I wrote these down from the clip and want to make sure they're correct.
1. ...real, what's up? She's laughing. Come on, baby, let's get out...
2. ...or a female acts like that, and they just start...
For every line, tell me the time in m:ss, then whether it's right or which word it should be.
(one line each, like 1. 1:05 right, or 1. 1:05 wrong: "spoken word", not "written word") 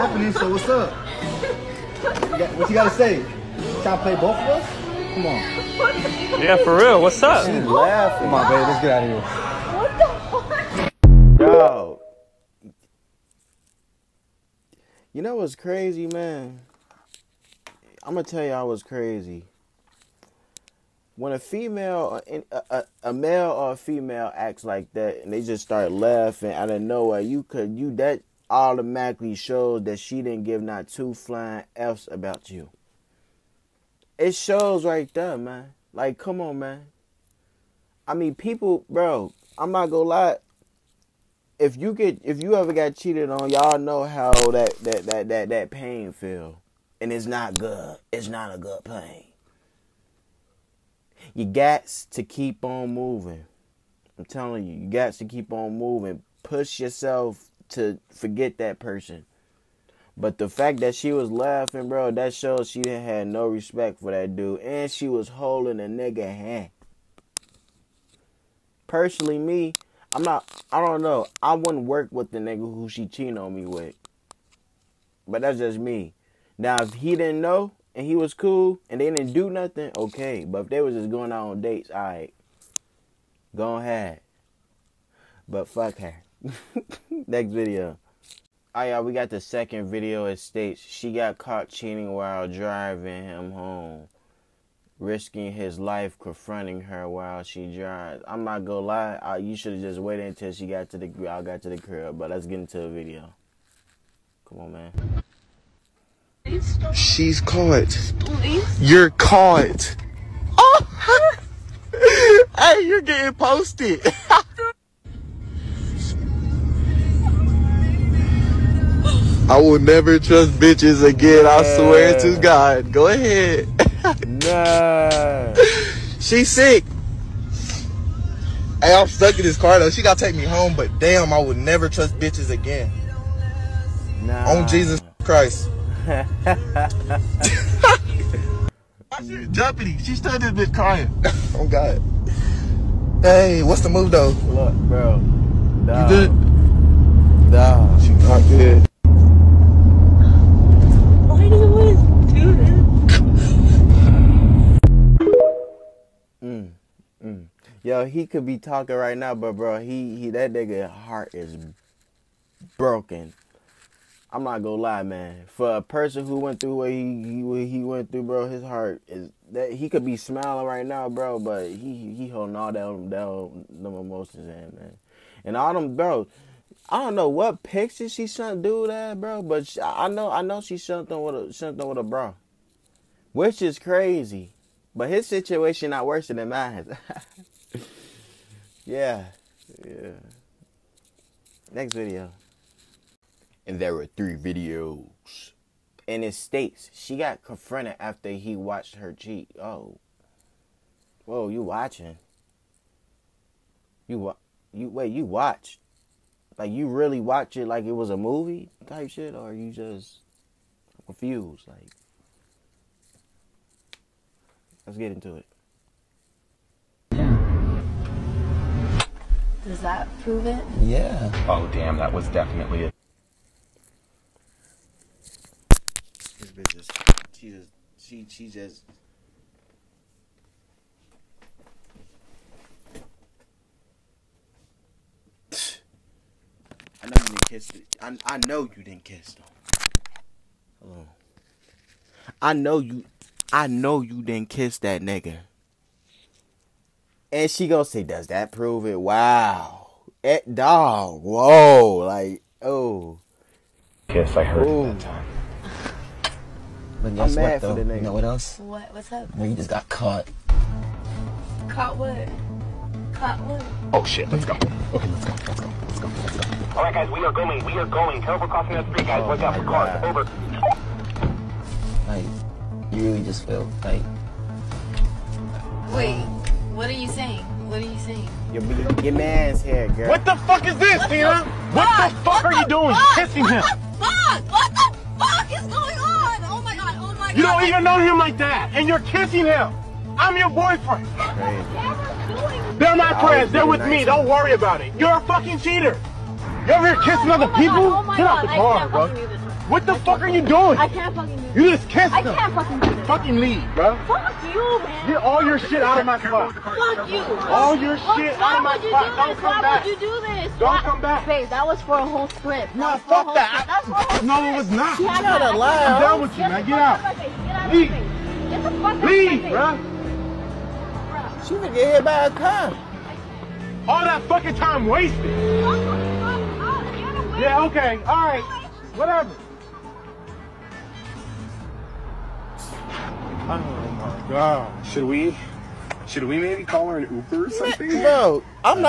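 1. 0:06 right
2. 0:23 right.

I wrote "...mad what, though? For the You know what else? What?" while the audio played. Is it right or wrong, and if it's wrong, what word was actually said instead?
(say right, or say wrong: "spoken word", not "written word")
right.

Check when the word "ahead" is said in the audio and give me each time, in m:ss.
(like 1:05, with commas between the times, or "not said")
1:23, 2:03.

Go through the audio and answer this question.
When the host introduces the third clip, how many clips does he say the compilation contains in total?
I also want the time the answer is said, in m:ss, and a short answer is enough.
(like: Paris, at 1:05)
3, at 3:14.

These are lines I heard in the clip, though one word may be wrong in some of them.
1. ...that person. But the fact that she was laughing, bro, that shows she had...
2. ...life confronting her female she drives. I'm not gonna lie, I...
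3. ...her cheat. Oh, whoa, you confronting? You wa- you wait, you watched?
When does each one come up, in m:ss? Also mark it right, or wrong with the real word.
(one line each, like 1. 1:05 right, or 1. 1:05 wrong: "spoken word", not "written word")
1. 0:58 right
2. 1:35 wrong: "while", not "female"
3. 3:18 wrong: "watching", not "confronting".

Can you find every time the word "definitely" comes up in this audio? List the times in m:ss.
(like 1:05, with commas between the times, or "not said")
3:42.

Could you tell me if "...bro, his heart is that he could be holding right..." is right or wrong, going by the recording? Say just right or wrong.
wrong.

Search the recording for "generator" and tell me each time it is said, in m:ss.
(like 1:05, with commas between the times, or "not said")
not said.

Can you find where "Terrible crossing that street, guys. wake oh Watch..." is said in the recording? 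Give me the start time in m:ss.
4:28.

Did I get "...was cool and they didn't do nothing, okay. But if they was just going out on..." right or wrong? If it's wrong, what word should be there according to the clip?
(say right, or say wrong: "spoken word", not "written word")
right.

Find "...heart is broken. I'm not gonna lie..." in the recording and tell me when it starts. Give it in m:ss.
2:40.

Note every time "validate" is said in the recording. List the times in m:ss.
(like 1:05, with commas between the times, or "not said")
not said.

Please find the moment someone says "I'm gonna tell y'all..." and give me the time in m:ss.
0:18.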